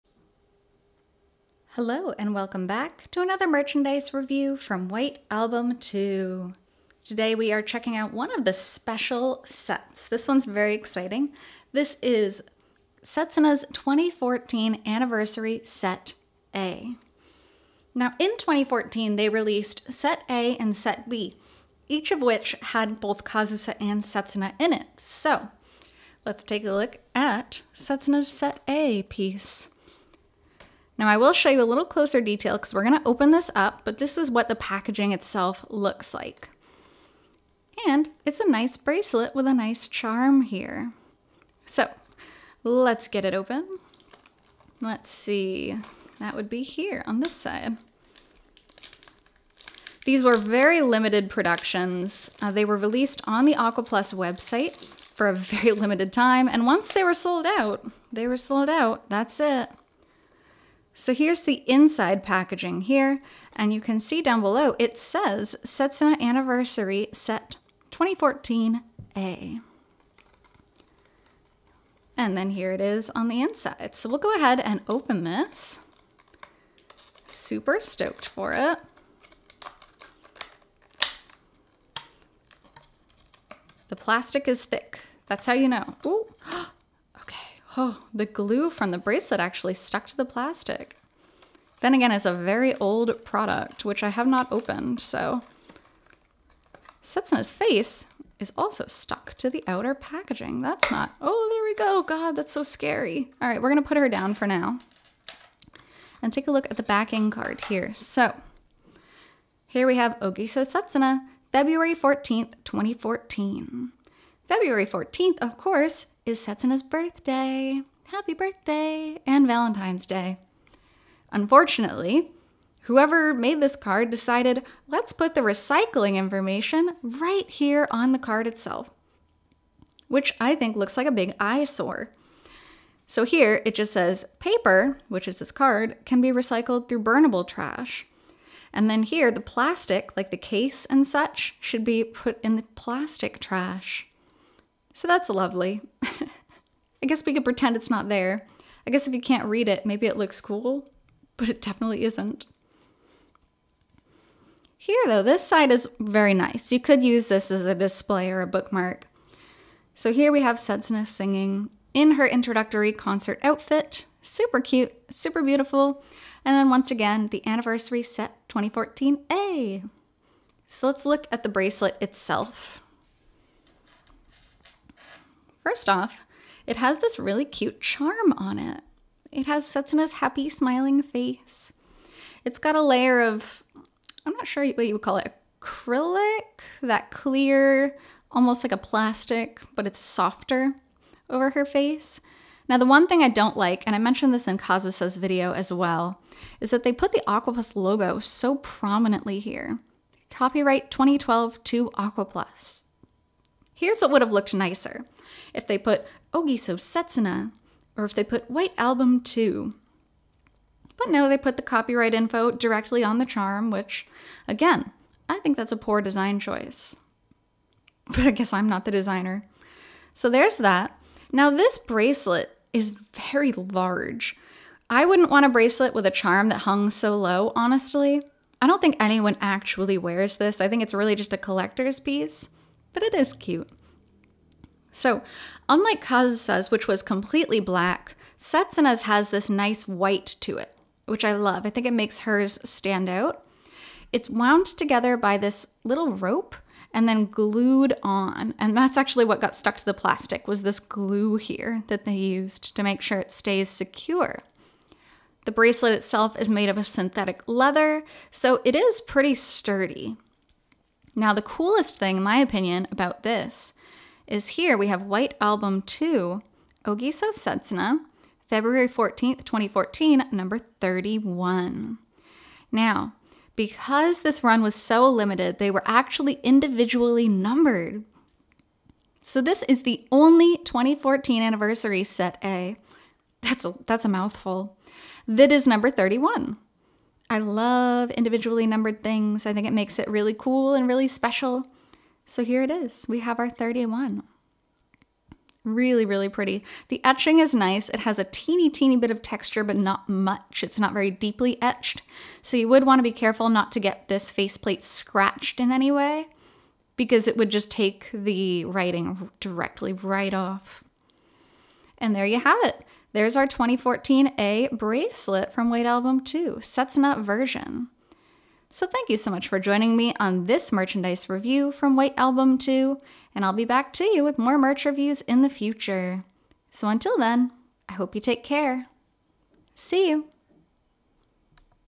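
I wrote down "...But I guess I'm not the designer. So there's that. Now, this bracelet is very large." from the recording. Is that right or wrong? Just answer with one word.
right.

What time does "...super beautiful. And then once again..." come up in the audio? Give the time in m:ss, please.
2:45.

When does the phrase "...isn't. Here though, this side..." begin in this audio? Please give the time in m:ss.
2:32.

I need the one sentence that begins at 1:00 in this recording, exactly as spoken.
So here's the inside packaging here, and you can see down below it says Setsuna Anniversary Set 2014A.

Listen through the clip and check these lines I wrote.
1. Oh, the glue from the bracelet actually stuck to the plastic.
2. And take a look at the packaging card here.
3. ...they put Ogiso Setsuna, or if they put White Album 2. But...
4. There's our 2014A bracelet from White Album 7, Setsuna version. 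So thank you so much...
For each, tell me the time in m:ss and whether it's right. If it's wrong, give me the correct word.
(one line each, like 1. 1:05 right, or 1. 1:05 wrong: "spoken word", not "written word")
1. 1:27 right
2. 1:46 wrong: "backing", not "packaging"
3. 3:25 right
4. 5:13 wrong: "2", not "7".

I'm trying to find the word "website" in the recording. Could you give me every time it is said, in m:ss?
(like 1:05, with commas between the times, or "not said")
0:54.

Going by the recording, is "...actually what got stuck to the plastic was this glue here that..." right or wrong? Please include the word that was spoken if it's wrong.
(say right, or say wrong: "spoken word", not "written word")
right.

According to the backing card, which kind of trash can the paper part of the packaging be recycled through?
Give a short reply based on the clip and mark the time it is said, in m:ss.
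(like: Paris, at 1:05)
Burnable trash, at 2:17.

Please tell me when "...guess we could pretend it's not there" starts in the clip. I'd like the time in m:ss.
2:27.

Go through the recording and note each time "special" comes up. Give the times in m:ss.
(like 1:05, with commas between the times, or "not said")
0:08, 4:51.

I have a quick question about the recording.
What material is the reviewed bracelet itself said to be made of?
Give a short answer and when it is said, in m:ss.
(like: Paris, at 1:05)
Synthetic leather, at 4:16.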